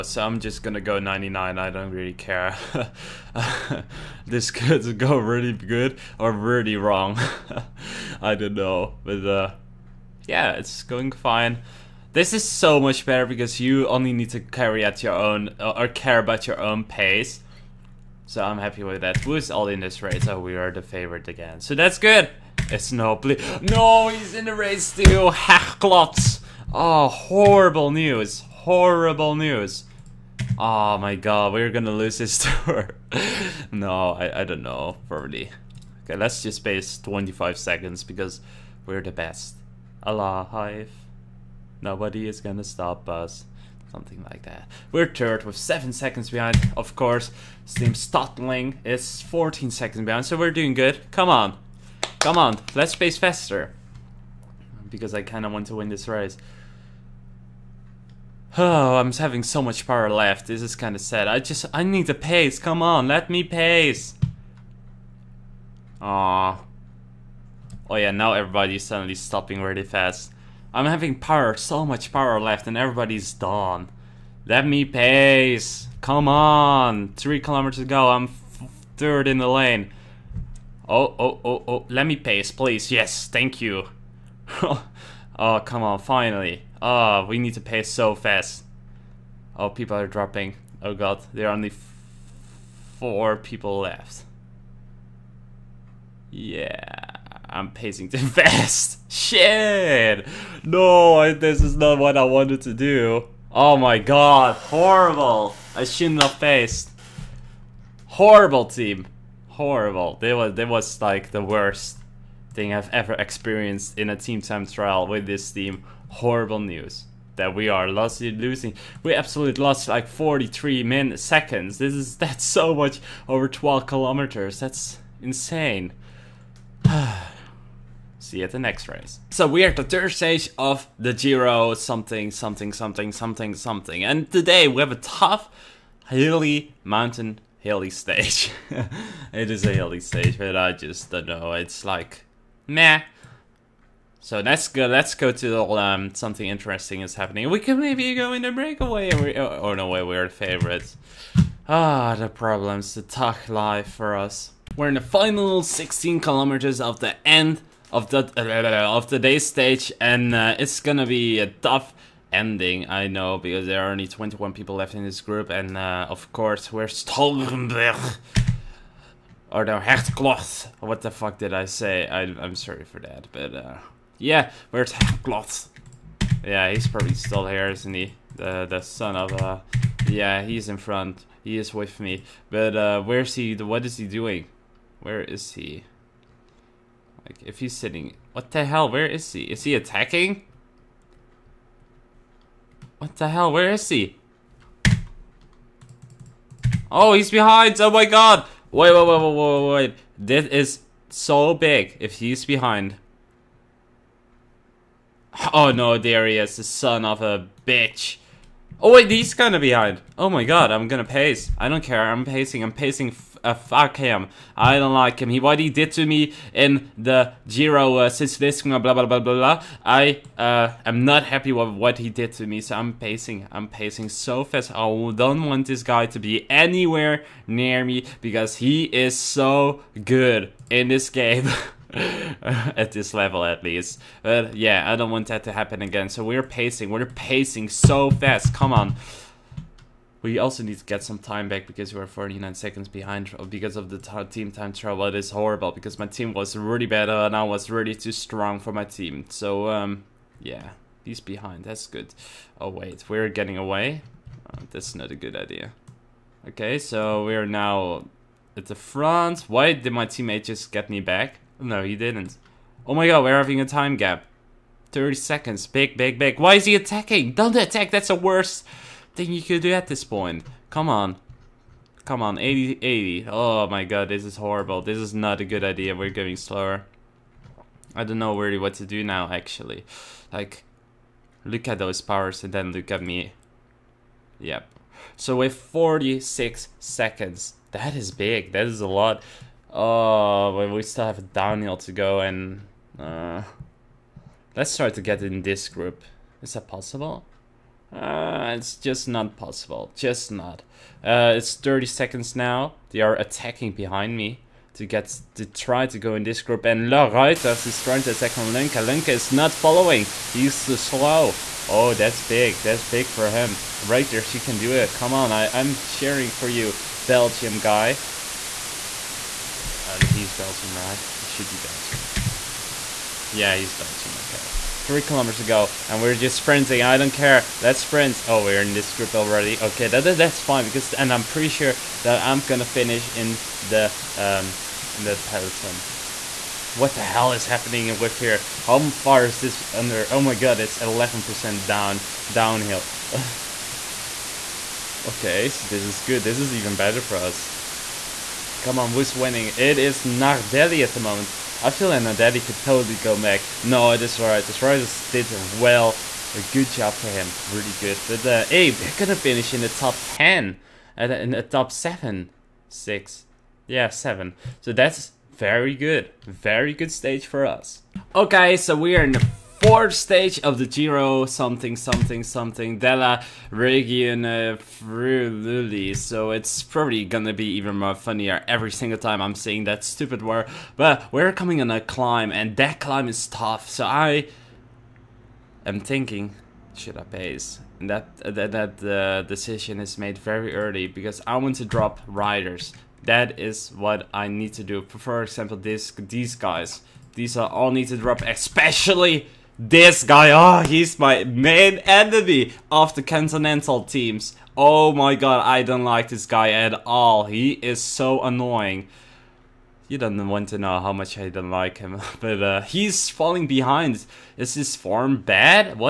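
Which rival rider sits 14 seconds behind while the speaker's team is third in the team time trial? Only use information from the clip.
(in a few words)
Steam Stölting.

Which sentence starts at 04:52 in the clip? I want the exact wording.
Uh, let's try to get in this group.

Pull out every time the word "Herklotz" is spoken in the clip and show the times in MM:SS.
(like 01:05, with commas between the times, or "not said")
00:25, 02:49, 02:54.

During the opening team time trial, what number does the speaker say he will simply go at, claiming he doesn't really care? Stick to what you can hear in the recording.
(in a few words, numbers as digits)
99.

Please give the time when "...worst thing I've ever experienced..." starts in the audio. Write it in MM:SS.
01:51.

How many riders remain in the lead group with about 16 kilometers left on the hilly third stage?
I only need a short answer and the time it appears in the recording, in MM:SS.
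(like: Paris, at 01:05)
21, at 02:44.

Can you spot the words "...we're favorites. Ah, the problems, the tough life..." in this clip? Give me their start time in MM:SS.
02:30.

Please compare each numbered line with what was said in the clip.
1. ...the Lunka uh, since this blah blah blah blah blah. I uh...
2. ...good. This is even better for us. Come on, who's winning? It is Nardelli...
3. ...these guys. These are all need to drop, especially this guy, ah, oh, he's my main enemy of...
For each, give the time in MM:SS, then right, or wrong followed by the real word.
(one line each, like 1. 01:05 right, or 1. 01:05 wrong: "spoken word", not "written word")
1. 03:36 wrong: "Giro", not "Lunka"
2. 05:46 right
3. 06:36 right.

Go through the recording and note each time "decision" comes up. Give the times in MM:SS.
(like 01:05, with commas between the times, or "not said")
06:29.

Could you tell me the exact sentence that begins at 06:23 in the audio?
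So I am thinking, should I pace?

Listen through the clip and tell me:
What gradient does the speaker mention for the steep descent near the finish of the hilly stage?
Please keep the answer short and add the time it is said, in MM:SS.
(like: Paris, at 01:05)
11%, at 05:40.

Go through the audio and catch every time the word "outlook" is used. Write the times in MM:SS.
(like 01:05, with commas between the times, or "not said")
not said.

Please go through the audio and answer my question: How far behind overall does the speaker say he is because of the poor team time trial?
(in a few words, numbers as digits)
49 seconds.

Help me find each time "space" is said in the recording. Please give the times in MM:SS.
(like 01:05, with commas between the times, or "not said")
00:36, 00:52.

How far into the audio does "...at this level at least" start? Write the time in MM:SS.
03:52.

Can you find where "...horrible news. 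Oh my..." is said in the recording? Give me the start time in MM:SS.
00:28.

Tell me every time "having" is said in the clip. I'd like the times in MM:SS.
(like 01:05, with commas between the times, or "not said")
00:59, 01:10, 04:23.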